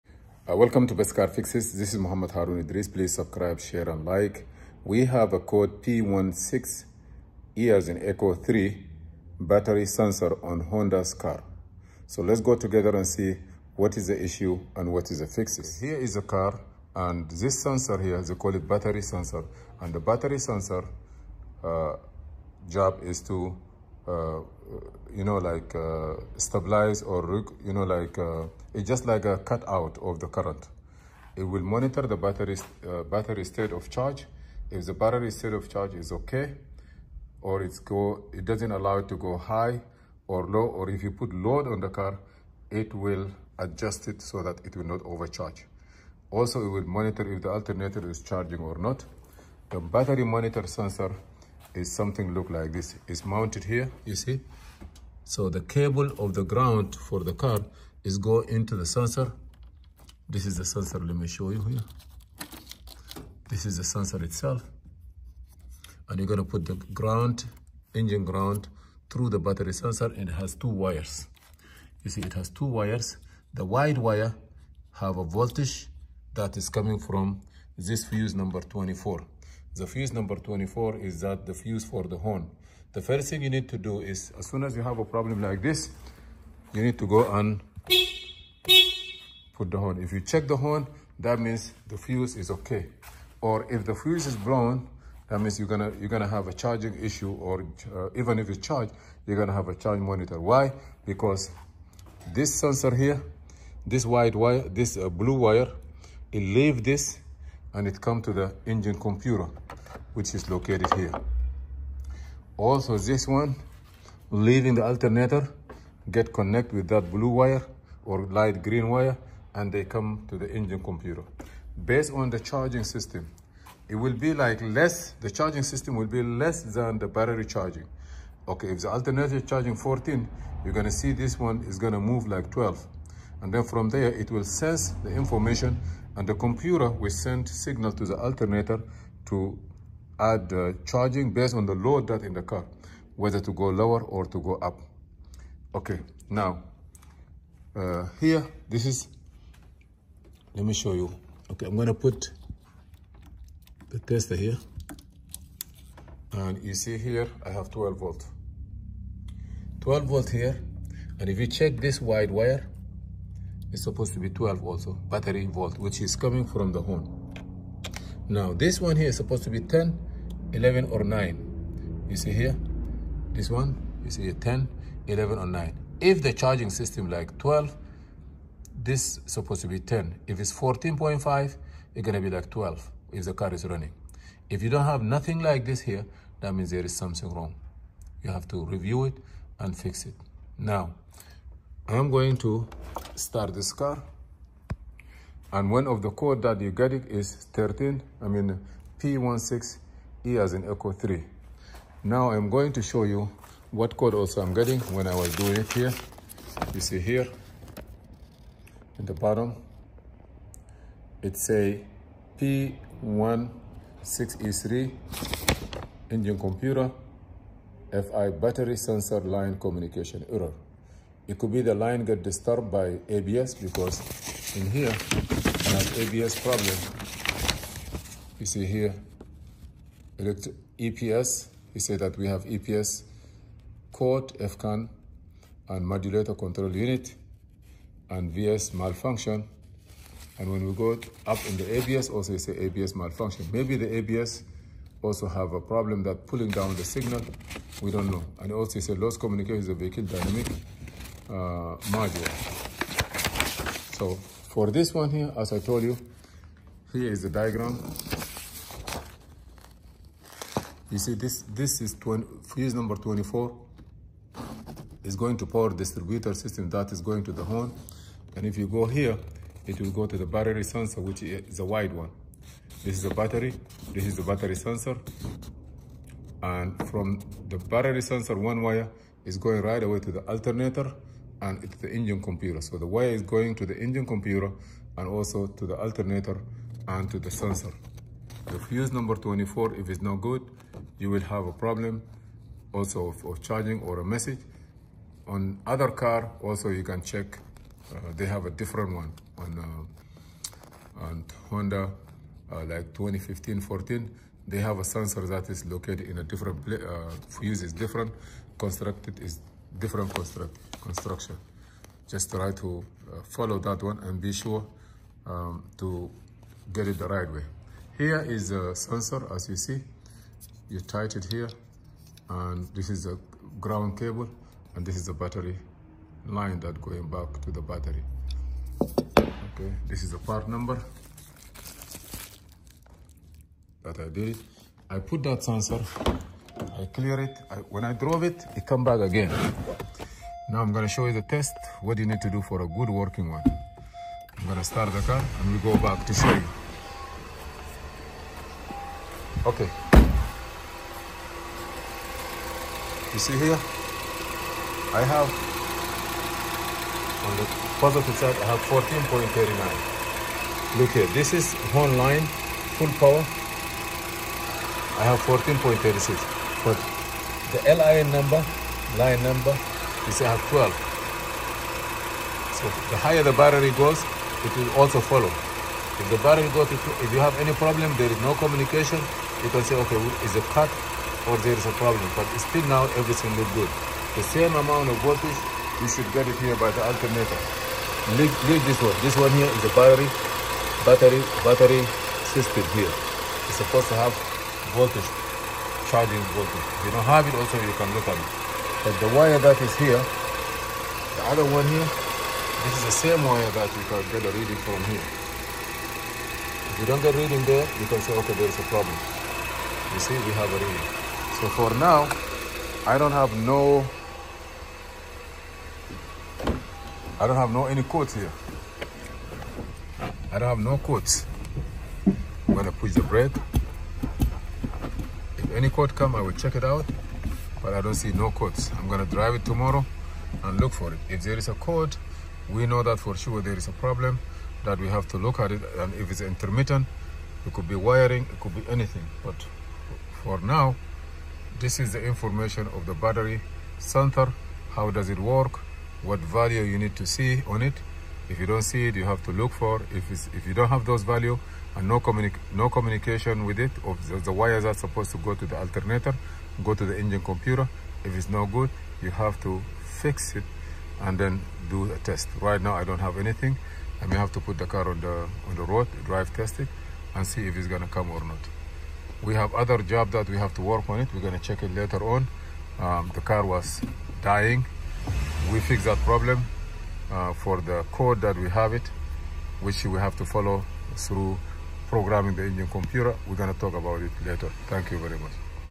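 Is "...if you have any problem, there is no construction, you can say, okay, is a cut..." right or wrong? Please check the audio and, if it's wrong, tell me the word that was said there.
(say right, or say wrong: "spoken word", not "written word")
wrong: "communication", not "construction".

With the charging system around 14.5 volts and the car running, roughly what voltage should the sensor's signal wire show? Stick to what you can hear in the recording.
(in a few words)
12.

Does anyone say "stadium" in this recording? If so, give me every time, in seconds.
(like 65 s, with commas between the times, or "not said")
not said.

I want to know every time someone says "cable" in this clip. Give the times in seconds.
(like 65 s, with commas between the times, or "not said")
55 s, 323 s.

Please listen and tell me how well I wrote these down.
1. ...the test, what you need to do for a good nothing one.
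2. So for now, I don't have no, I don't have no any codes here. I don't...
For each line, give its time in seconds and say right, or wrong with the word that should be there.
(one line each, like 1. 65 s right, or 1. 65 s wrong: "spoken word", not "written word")
1. 341 s wrong: "working", not "nothing"
2. 411 s right.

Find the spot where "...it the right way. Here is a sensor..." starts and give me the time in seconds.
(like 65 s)
316 s.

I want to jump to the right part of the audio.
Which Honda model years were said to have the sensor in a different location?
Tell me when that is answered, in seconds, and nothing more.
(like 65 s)
302 s.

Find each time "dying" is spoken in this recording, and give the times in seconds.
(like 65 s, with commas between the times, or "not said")
474 s.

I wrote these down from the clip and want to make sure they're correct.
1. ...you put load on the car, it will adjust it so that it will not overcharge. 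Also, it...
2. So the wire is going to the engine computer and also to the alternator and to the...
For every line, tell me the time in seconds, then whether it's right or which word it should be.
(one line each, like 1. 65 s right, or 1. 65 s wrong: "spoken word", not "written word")
1. 41 s right
2. 282 s right.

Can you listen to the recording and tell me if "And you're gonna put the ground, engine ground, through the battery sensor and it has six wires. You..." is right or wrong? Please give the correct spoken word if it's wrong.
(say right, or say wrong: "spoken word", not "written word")
wrong: "two", not "six".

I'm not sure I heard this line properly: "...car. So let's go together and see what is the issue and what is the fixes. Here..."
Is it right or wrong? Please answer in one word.
right.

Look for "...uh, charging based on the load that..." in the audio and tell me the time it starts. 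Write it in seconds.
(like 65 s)
140 s.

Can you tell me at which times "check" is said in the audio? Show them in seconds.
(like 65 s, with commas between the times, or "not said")
90 s, 161 s, 297 s, 426 s, 471 s.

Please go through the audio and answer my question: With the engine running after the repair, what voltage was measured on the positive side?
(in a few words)
14.39.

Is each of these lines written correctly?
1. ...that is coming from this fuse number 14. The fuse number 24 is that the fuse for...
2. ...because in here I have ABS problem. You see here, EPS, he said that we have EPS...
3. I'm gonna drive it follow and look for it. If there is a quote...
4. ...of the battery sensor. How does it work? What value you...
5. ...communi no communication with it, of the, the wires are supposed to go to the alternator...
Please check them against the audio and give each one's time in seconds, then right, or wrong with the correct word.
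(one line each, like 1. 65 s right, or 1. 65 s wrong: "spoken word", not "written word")
1. 76 s wrong: "24", not "14"
2. 223 s right
3. 428 s wrong: "tomorrow", not "follow"
4. 442 s right
5. 452 s right.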